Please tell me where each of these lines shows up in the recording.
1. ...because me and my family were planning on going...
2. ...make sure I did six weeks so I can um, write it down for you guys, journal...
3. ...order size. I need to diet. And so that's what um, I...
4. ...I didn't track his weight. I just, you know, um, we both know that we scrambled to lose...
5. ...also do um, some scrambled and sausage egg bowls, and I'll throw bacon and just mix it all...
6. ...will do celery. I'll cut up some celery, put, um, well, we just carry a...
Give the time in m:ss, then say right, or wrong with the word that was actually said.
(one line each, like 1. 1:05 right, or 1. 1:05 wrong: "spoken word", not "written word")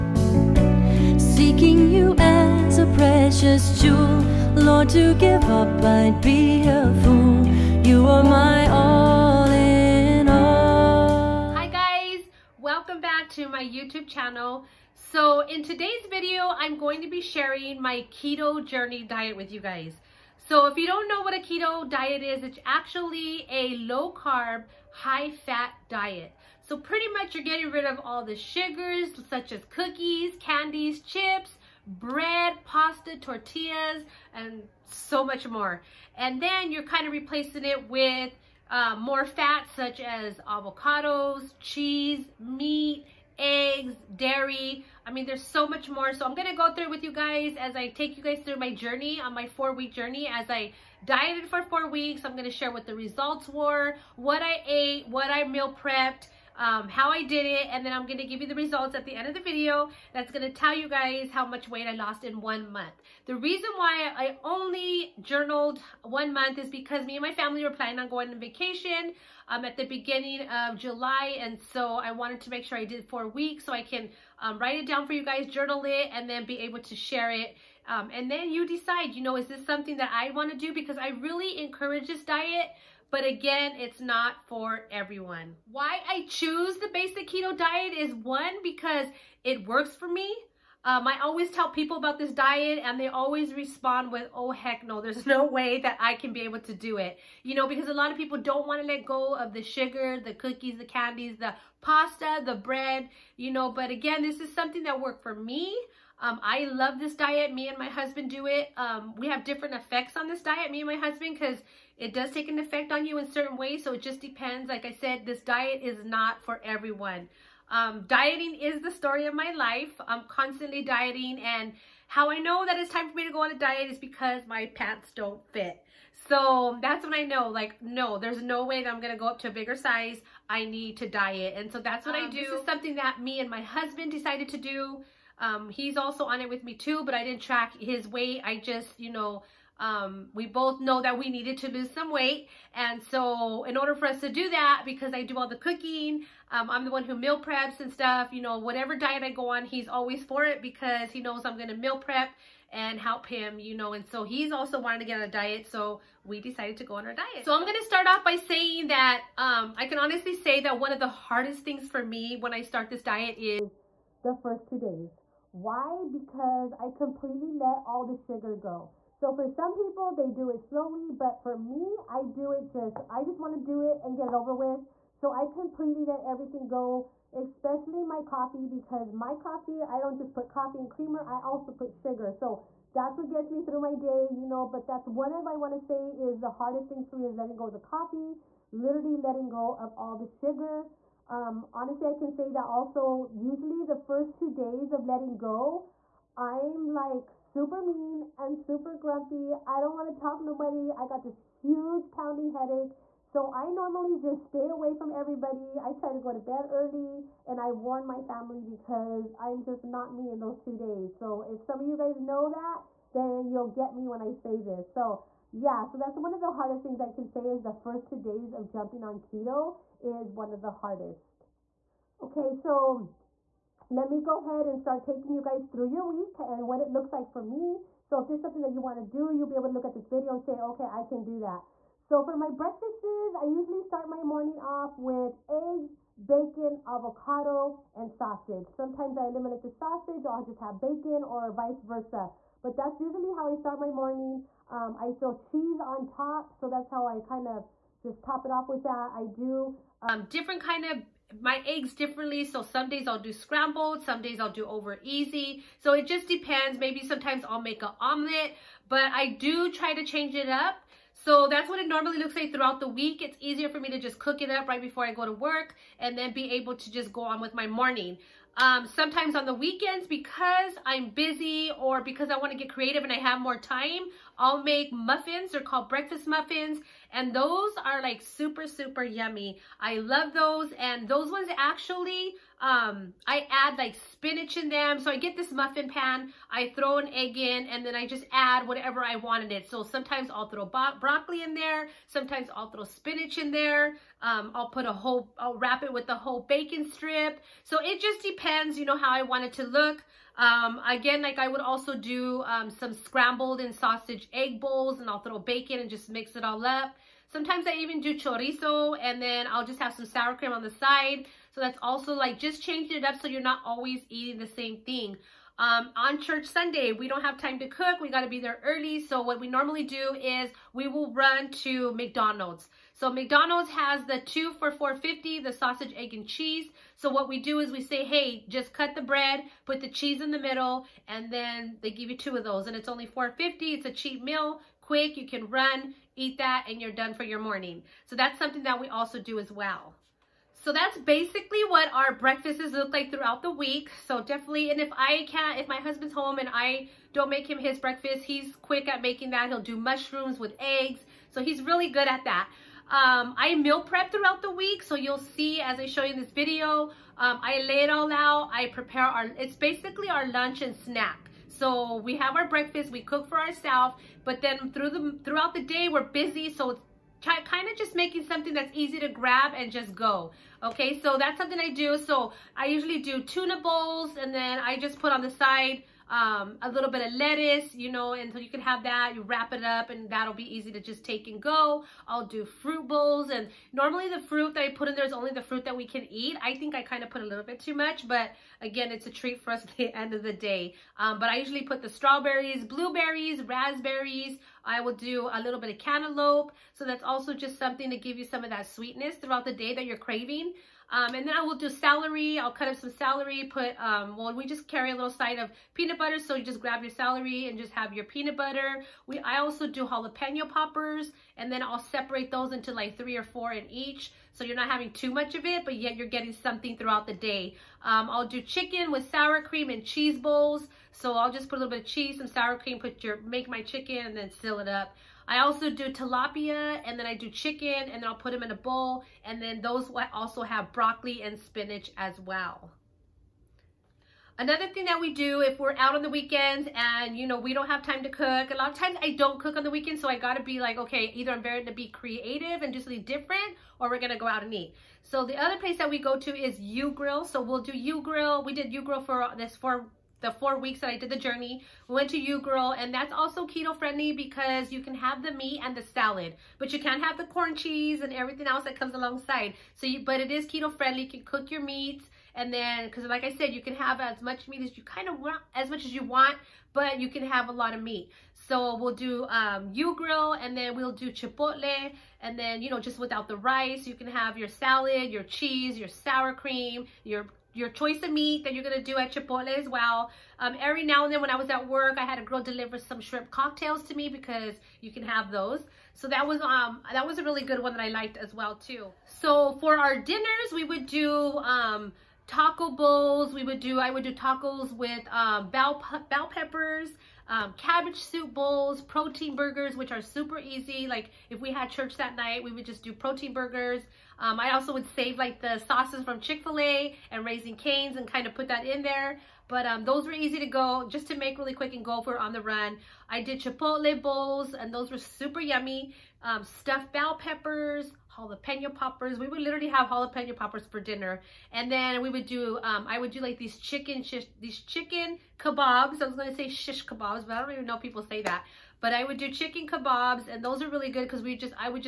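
1. 1:06 right
2. 1:12 wrong: "four", not "six"
3. 2:09 wrong: "bigger", not "order"
4. 2:17 wrong: "needed", not "scrambled"
5. 5:01 right
6. 6:41 right.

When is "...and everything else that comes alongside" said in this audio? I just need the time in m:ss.
7:38.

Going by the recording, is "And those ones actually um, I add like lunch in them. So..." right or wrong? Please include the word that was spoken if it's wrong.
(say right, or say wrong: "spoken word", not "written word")
wrong: "spinach", not "lunch".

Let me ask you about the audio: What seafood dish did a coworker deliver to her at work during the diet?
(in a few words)
Shrimp cocktails.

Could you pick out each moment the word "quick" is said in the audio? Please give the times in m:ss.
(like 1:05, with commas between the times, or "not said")
5:34, 5:48, 8:31.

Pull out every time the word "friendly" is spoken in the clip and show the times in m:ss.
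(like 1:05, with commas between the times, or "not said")
7:33, 7:40.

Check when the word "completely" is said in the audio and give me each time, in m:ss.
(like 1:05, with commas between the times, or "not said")
2:46, 2:55.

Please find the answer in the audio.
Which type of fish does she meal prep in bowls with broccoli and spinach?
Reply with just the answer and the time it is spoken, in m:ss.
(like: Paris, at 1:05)
Tilapia, at 7:05.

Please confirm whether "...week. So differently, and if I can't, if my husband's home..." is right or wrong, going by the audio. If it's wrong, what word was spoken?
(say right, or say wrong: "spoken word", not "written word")
wrong: "definitely", not "differently".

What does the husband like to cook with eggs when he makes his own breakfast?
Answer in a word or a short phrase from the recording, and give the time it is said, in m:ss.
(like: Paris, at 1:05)
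Mushrooms, at 5:49.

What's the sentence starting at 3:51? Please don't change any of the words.
So for my breakfasts, I usually start my morning off with eggs, bacon, avocado, and sausage.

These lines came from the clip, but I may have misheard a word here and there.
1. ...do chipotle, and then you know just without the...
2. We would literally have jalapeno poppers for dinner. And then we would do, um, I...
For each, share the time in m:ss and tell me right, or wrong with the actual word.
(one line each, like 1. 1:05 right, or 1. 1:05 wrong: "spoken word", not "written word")
1. 7:50 right
2. 8:39 right.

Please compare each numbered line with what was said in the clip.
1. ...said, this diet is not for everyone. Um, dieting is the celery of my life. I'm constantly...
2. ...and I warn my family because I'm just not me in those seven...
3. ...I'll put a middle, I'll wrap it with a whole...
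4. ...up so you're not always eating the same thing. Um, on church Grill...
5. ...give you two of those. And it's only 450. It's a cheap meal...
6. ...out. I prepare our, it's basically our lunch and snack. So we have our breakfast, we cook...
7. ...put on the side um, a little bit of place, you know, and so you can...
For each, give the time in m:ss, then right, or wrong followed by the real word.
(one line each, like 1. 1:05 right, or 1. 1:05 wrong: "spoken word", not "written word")
1. 1:55 wrong: "story", not "celery"
2. 3:27 wrong: "two", not "seven"
3. 4:54 wrong: "whole", not "middle"
4. 5:13 wrong: "Sunday", not "Grill"
5. 5:31 right
6. 5:58 right
7. 6:14 wrong: "lettuce", not "place".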